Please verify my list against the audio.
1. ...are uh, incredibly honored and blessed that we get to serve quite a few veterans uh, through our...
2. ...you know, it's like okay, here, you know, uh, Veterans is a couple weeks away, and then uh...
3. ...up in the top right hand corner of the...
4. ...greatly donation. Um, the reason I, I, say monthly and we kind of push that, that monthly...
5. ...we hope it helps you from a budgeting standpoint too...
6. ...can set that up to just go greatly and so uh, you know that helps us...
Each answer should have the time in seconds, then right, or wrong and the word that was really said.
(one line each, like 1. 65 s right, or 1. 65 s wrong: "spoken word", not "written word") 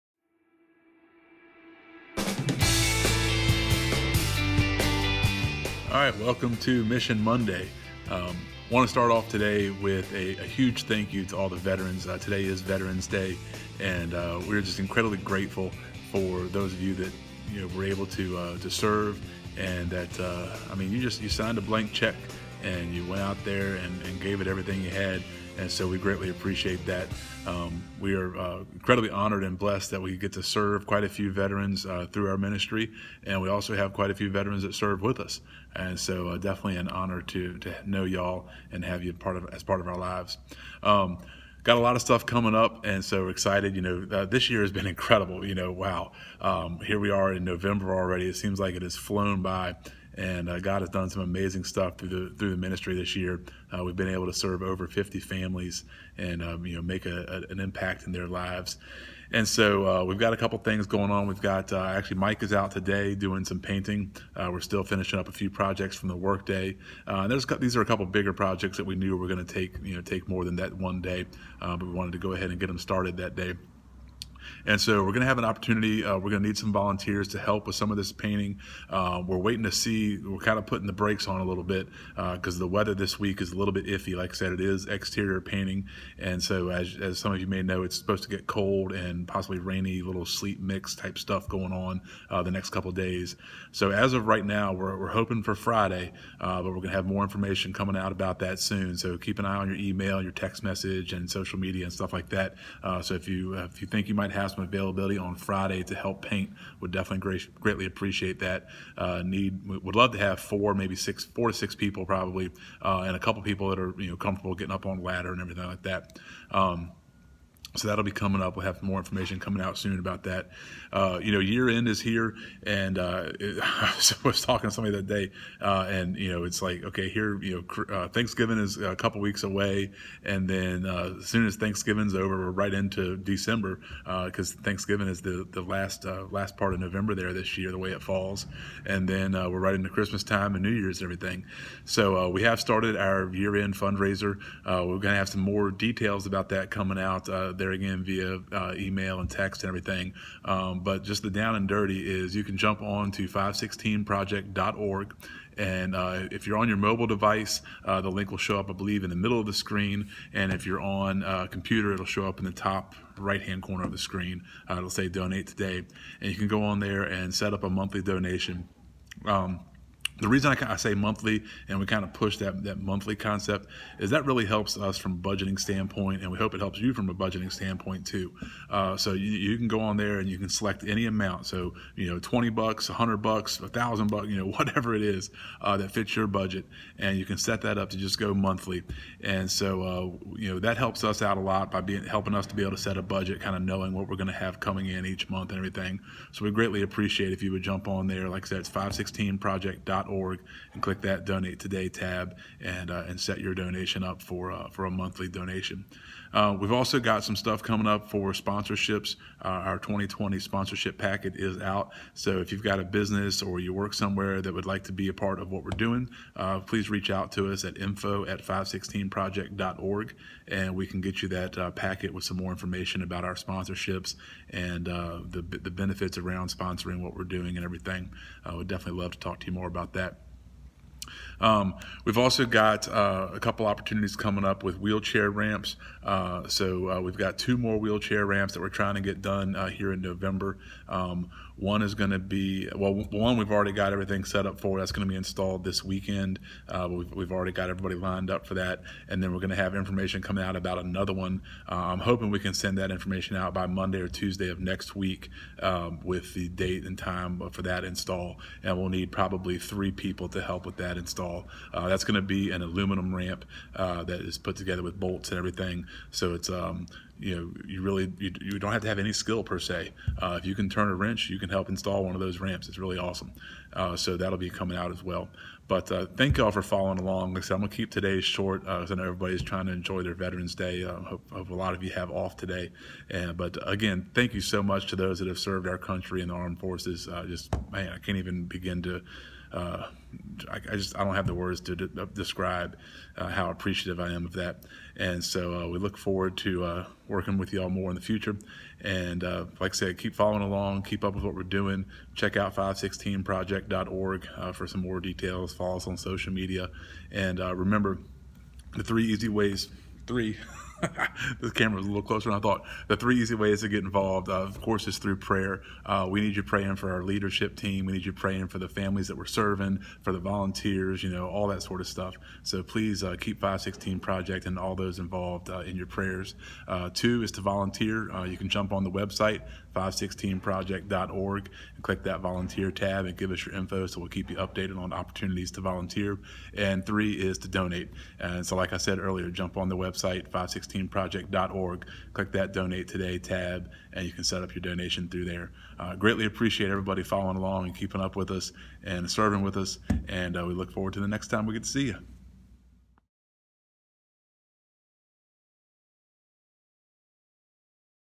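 1. 28 s right
2. 126 s wrong: "Thanksgiving", not "Veterans"
3. 162 s right
4. 167 s wrong: "monthly", not "greatly"
5. 176 s right
6. 187 s wrong: "monthly", not "greatly".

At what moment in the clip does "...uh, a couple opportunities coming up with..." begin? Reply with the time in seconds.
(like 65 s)
232 s.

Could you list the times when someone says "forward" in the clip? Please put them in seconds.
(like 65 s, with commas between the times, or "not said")
295 s, 350 s.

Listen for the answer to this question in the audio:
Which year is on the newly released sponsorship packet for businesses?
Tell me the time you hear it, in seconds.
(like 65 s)
209 s.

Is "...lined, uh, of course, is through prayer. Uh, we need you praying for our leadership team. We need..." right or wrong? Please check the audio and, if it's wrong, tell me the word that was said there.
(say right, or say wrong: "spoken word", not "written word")
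wrong: "involved", not "lined".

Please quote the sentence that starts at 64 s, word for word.
Uh, we're still finishing up a few projects from the workday.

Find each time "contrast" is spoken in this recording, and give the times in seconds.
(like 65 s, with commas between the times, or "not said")
not said.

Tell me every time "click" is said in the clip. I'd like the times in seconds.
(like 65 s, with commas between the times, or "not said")
200 s, 331 s, 342 s.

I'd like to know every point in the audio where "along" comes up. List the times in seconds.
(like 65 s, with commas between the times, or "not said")
276 s, 300 s, 347 s.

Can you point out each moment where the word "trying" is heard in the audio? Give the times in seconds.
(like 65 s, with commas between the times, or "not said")
238 s, 279 s.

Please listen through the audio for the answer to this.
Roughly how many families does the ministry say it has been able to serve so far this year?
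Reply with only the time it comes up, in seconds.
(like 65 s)
54 s.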